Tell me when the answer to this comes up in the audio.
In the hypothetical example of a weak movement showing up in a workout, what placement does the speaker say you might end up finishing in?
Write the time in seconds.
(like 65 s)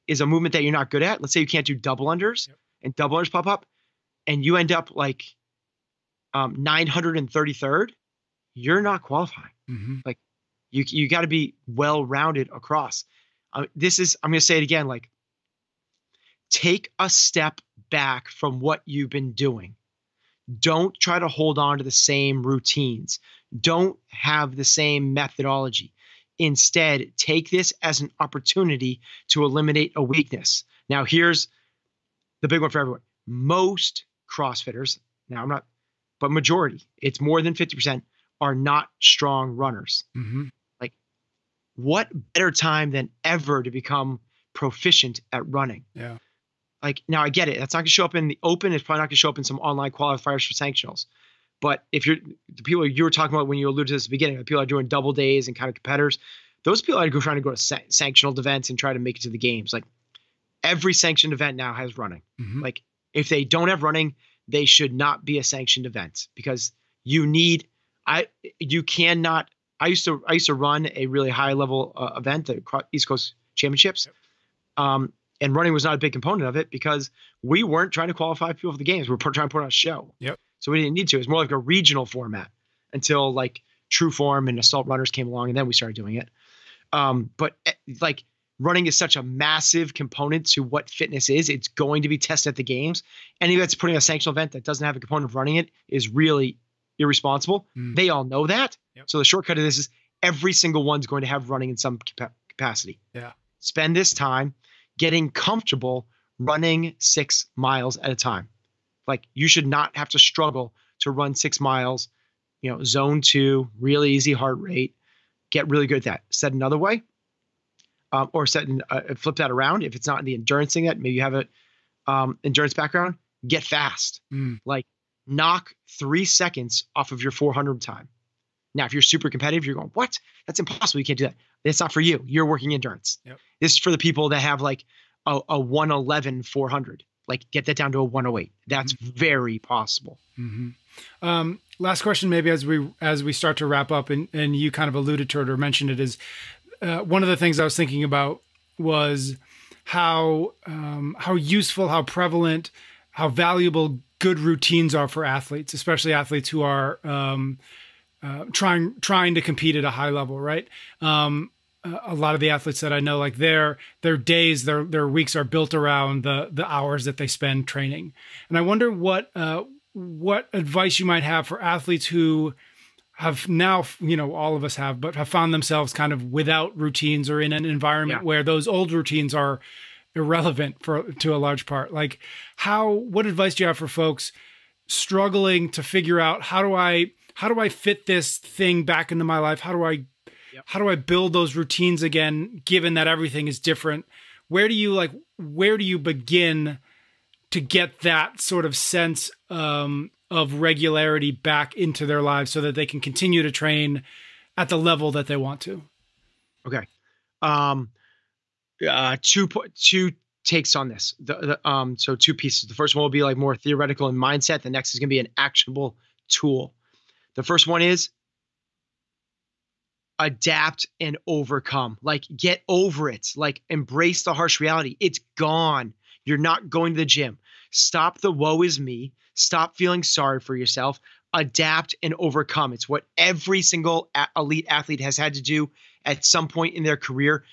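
6 s.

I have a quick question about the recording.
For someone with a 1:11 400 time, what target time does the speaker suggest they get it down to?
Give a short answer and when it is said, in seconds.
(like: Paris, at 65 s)
1:08, at 138 s.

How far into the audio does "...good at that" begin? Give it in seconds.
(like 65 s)
115 s.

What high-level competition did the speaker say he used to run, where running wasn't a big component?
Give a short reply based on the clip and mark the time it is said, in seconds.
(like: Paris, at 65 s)
East Coast Championships, at 72 s.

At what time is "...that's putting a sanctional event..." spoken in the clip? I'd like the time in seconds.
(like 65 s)
93 s.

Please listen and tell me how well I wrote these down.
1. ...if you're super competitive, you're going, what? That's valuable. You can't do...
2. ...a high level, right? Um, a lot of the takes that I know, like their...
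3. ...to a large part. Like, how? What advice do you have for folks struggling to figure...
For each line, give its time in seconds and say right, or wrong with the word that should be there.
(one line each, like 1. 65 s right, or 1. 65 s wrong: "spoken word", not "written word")
1. 128 s wrong: "impossible", not "valuable"
2. 159 s wrong: "athletes", not "takes"
3. 181 s right.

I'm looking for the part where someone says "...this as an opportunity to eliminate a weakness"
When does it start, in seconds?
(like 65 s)
27 s.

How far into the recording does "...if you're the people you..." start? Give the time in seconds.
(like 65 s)
51 s.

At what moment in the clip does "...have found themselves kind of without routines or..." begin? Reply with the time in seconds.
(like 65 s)
175 s.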